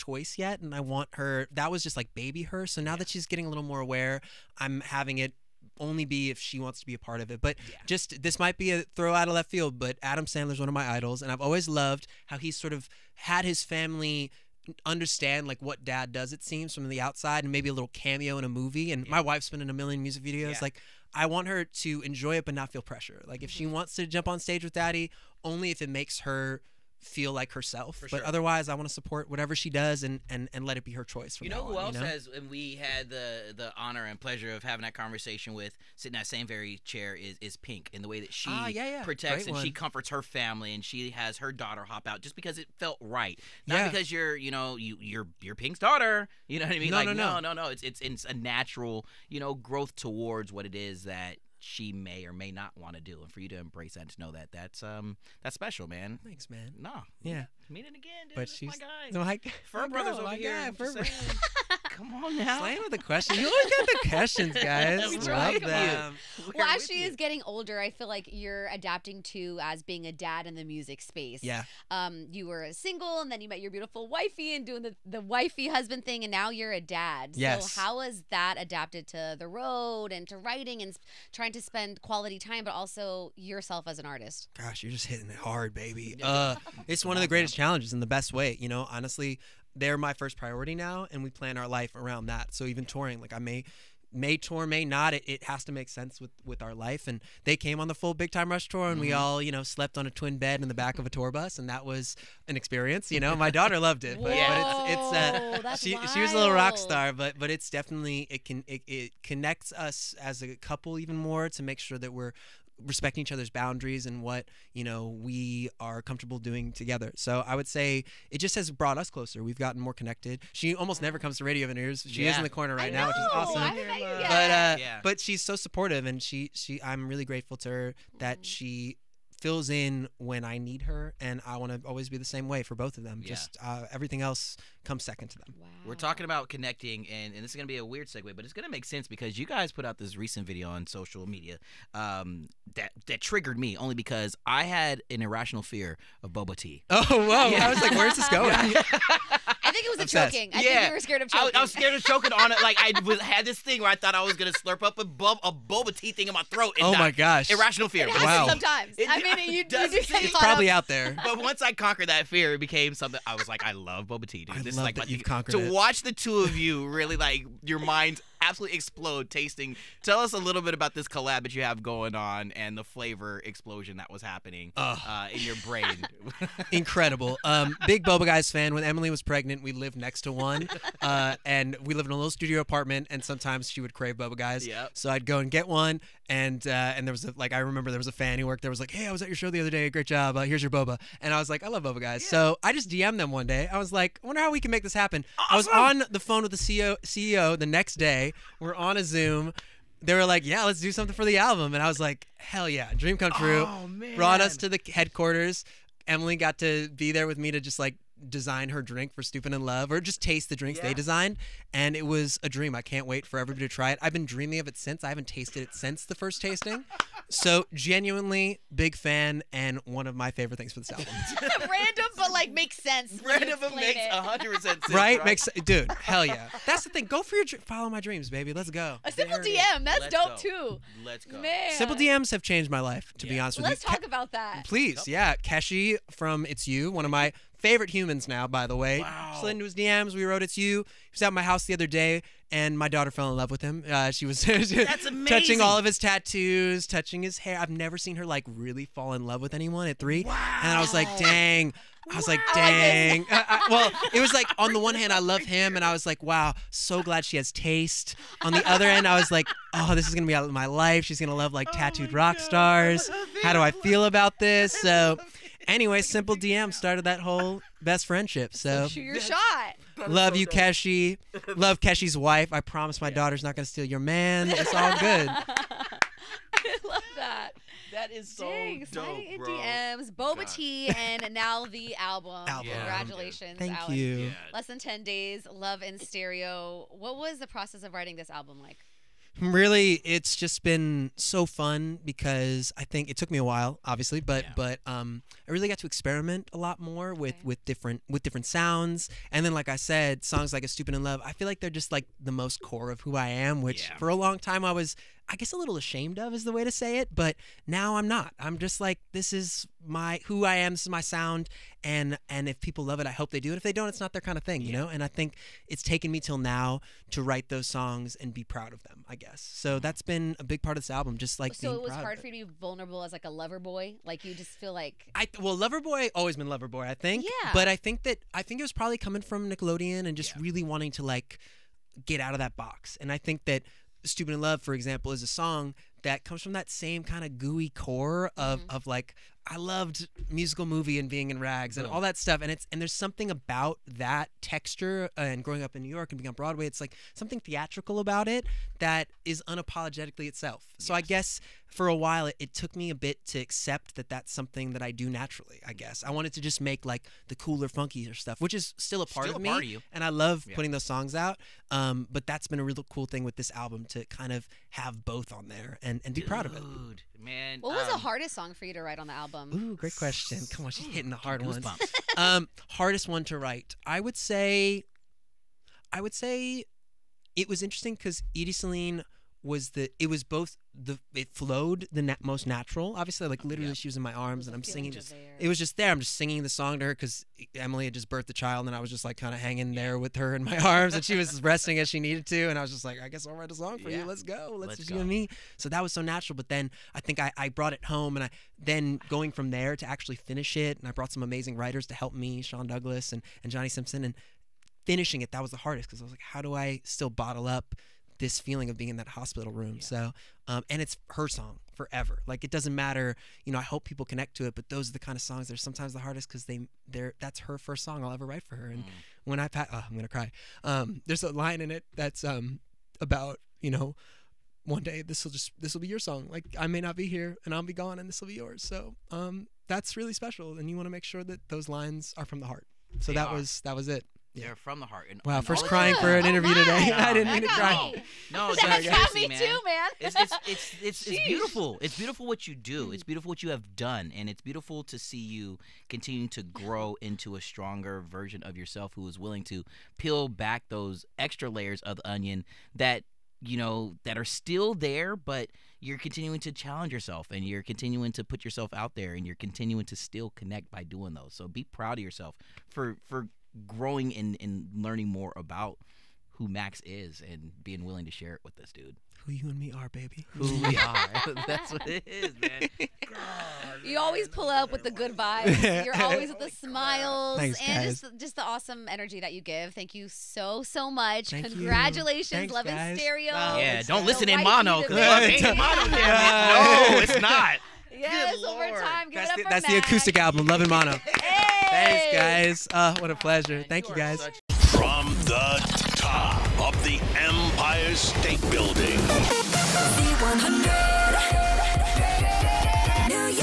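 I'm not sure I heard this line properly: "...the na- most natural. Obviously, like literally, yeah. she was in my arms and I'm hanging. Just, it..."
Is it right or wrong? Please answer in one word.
wrong.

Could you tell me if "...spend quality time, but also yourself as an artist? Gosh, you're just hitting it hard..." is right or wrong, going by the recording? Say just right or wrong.
right.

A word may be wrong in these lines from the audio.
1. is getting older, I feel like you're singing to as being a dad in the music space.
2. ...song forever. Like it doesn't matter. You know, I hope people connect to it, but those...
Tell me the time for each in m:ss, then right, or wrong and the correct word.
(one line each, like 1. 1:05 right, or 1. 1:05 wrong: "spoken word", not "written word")
1. 1:07 wrong: "adapting", not "singing"
2. 6:51 right.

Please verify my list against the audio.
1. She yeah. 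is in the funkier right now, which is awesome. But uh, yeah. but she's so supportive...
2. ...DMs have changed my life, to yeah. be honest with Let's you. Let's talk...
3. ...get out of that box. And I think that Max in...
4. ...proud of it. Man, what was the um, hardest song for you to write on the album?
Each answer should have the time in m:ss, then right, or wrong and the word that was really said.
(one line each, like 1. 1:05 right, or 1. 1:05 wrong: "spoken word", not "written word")
1. 2:02 wrong: "corner", not "funkier"
2. 3:51 right
3. 5:32 wrong: "Stupid", not "Max"
4. 6:06 right.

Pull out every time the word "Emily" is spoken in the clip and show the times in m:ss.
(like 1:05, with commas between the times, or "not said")
2:58, 3:26, 6:27.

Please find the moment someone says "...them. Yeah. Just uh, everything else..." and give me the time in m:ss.
2:13.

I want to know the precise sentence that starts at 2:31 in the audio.
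I, I was scared of choking on it.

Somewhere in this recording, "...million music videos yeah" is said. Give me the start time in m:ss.
0:19.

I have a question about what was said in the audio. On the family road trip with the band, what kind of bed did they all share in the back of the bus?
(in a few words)
Twin bed.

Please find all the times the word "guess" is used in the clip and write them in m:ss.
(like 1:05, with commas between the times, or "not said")
5:05, 5:19, 5:51, 5:55, 6:33.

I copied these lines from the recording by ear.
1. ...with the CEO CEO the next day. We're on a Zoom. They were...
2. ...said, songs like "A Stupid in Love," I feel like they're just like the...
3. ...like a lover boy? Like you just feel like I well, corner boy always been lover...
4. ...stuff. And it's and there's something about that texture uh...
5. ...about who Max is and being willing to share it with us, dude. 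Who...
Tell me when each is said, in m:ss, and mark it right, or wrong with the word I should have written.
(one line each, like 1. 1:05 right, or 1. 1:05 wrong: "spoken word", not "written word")
1. 3:16 right
2. 4:59 right
3. 5:23 wrong: "lover", not "corner"
4. 5:42 right
5. 7:45 right.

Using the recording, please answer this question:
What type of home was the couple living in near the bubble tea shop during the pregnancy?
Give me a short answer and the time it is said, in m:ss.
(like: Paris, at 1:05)
Studio apartment, at 3:02.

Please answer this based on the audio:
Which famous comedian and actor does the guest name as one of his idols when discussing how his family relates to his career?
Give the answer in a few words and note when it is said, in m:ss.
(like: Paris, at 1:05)
Adam Sandler, at 0:10.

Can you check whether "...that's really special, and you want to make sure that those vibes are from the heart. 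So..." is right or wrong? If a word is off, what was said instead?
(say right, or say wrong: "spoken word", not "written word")
wrong: "lines", not "vibes".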